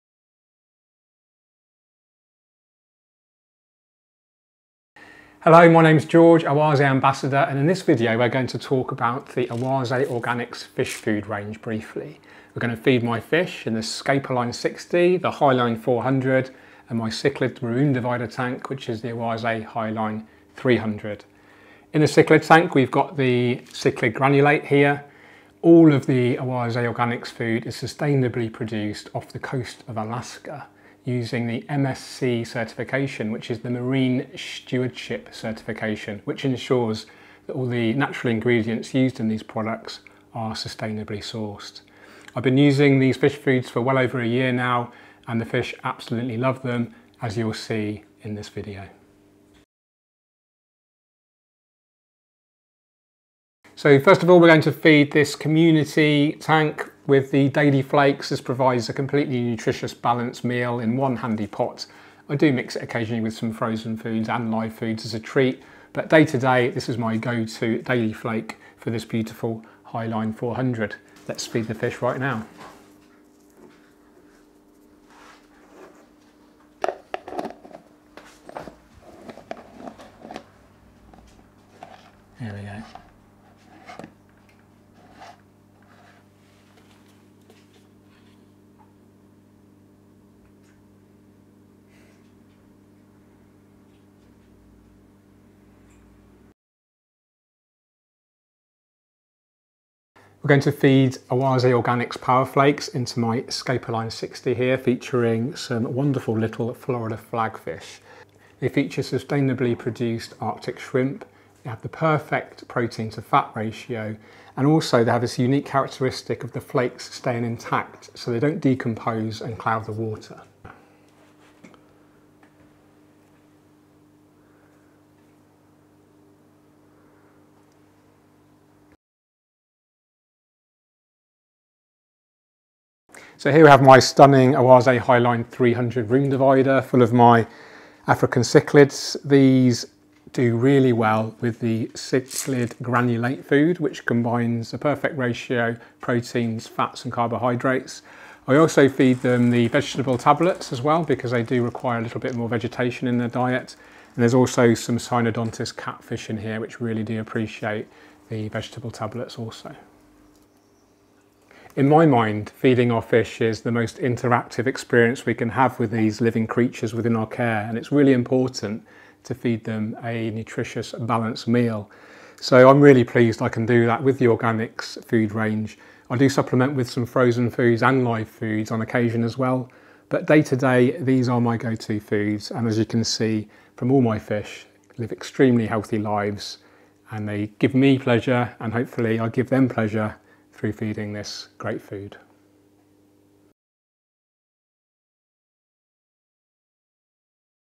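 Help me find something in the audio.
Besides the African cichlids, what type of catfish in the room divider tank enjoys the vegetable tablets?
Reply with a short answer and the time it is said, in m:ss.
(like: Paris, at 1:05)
Synodontis catfish, at 2:34.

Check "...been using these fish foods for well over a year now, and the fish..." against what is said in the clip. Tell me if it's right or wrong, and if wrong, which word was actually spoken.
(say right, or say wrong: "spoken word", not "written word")
right.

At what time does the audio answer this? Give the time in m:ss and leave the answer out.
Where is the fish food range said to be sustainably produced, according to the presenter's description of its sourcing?
0:29.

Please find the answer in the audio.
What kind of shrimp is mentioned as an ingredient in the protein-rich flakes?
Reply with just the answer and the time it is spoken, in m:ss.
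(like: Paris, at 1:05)
Arctic shrimp, at 1:50.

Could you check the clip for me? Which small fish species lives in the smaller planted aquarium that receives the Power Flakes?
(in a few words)
Florida flagfish.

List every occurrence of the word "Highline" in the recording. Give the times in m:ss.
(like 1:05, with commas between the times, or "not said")
0:15, 0:19, 1:09, 2:14.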